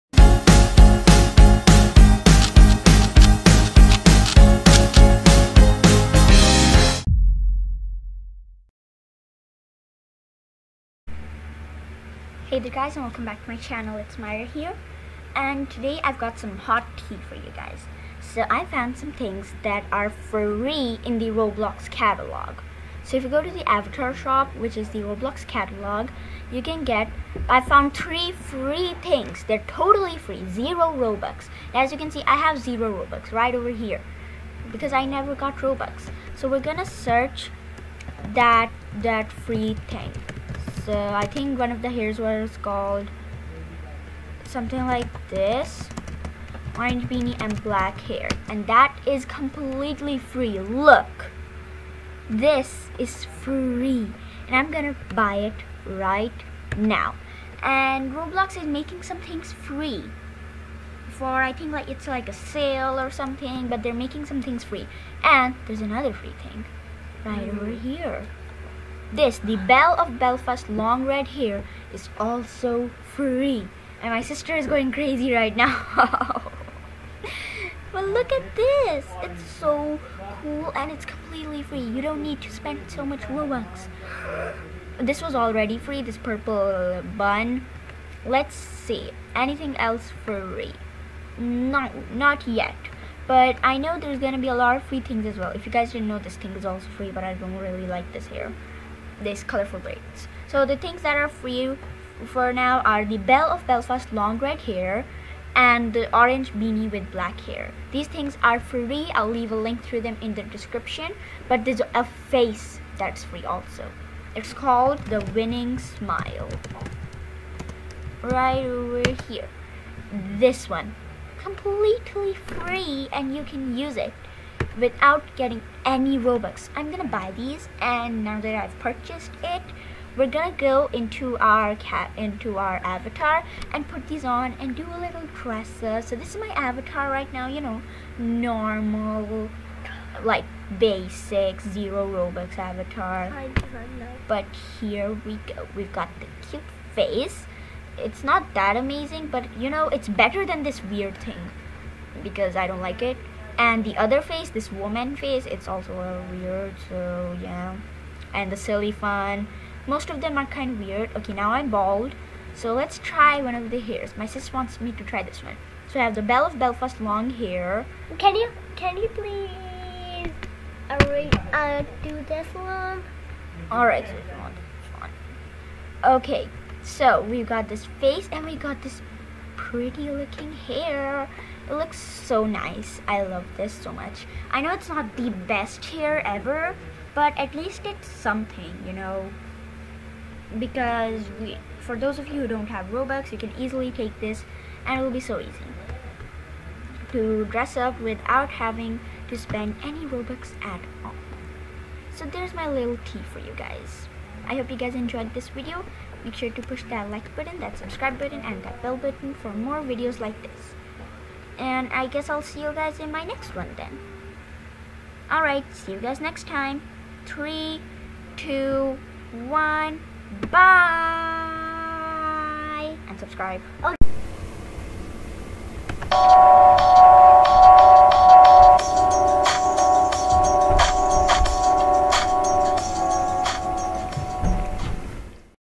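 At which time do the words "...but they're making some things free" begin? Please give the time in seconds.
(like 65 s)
63 s.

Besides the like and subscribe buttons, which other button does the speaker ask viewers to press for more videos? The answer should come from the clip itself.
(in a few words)
Bell button.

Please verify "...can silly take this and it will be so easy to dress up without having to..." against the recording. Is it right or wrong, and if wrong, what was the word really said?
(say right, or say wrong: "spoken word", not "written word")
wrong: "easily", not "silly".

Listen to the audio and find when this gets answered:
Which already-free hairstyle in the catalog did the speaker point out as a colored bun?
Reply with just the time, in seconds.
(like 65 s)
86 s.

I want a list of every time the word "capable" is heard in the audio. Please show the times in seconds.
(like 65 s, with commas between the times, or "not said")
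not said.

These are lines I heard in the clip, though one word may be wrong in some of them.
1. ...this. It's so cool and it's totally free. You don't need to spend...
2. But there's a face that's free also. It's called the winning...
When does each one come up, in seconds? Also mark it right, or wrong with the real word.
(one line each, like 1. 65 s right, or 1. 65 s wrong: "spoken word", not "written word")
1. 78 s wrong: "completely", not "totally"
2. 111 s right.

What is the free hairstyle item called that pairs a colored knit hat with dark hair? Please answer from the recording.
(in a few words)
Orange beanie and black hair.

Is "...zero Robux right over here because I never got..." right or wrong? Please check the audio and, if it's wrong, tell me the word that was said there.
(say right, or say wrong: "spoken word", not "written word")
right.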